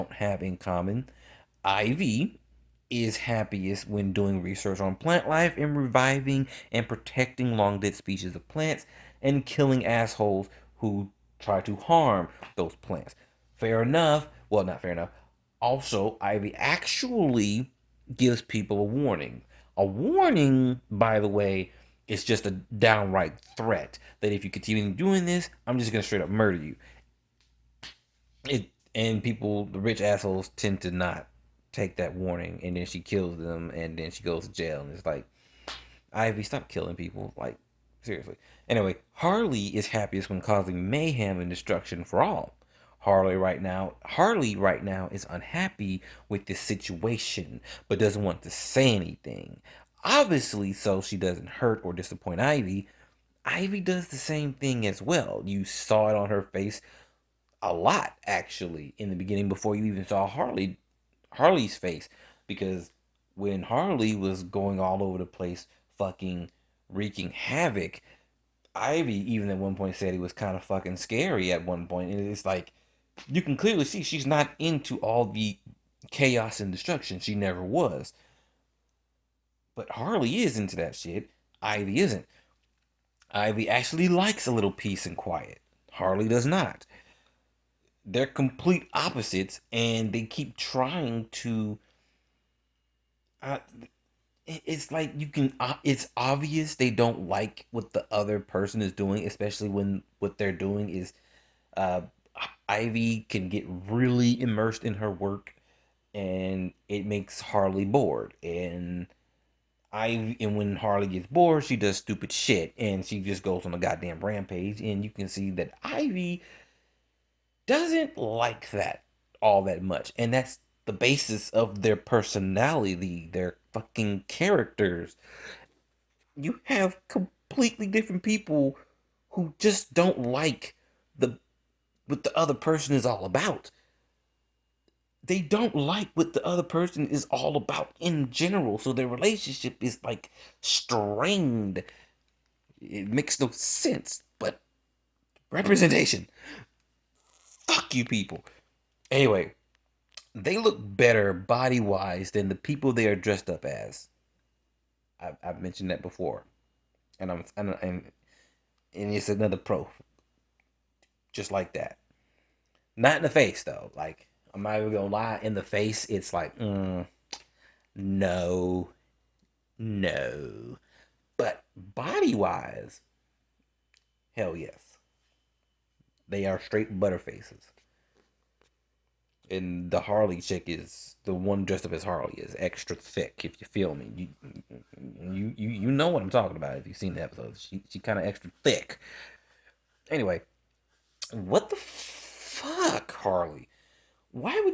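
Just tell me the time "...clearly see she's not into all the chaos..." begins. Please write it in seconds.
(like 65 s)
73 s.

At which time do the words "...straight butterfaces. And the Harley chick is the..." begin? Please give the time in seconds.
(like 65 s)
176 s.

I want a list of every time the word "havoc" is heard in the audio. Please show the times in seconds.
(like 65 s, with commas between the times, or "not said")
67 s.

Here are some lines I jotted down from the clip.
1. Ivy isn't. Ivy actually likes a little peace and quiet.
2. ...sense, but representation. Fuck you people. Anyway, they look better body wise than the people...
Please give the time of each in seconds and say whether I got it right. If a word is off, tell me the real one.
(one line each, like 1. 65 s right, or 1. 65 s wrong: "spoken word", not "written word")
1. 81 s right
2. 143 s right.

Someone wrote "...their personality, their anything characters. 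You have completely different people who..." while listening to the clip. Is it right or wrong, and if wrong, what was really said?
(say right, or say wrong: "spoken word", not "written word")
wrong: "fucking", not "anything".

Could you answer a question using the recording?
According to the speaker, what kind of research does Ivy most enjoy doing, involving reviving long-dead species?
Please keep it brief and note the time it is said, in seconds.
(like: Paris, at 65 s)
plant life, at 4 s.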